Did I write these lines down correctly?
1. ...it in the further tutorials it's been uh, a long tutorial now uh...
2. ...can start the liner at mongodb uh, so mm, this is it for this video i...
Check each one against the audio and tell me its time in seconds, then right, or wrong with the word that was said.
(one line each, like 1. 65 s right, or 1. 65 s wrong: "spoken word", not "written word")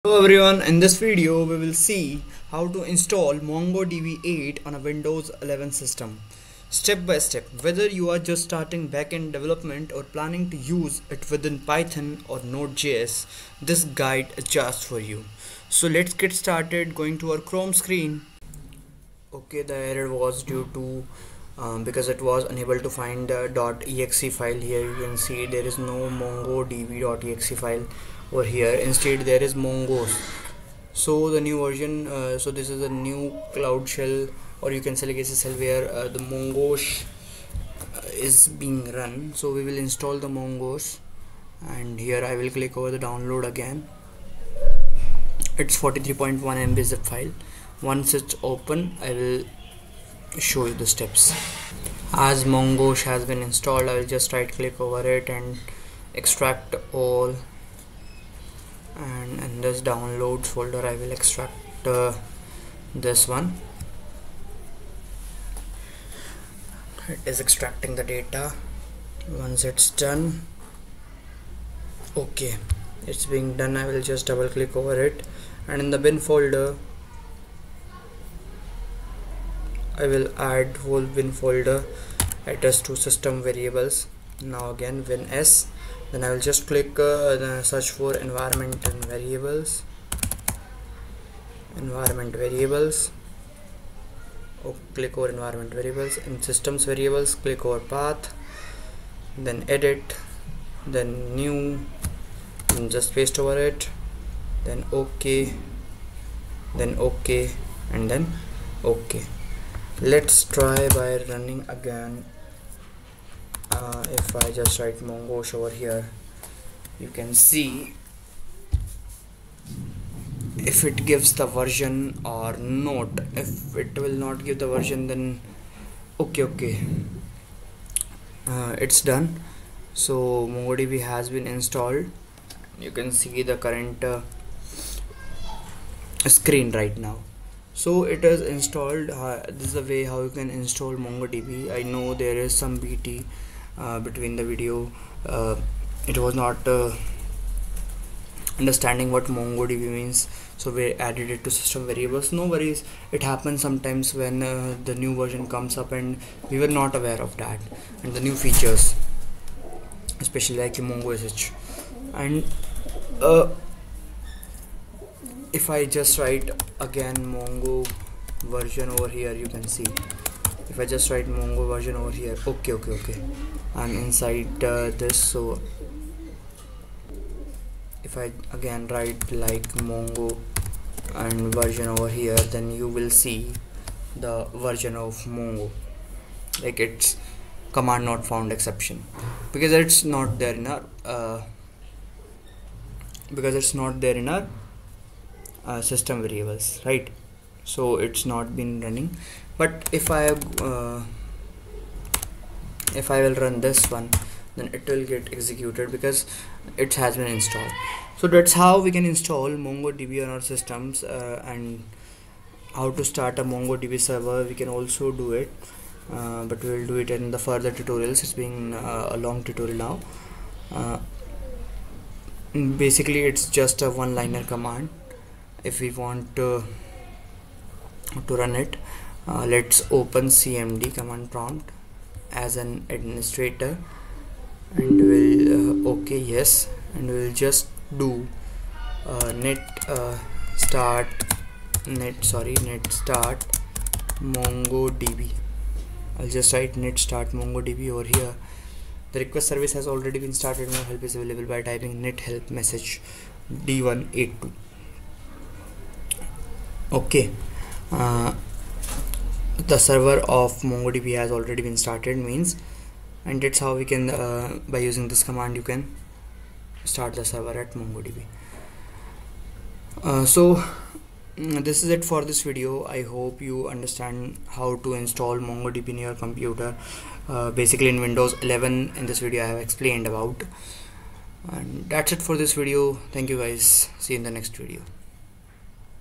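1. 217 s right
2. 265 s wrong: "server", not "liner".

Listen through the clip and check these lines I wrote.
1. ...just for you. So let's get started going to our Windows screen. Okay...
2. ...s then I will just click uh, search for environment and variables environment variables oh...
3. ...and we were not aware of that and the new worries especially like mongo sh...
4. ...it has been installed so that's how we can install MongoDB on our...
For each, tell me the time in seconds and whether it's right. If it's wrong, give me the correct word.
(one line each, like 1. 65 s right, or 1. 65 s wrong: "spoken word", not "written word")
1. 14 s wrong: "Chrome", not "Windows"
2. 85 s right
3. 155 s wrong: "features", not "worries"
4. 206 s right.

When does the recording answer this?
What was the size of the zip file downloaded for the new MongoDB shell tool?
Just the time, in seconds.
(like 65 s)
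45 s.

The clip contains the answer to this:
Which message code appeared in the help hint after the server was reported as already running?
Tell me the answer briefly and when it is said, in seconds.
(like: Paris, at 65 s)
d182, at 253 s.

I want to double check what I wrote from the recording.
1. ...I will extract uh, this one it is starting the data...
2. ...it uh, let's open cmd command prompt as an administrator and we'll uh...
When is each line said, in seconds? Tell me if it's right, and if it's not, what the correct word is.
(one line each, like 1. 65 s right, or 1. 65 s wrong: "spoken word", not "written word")
1. 60 s wrong: "extracting", not "starting"
2. 228 s right.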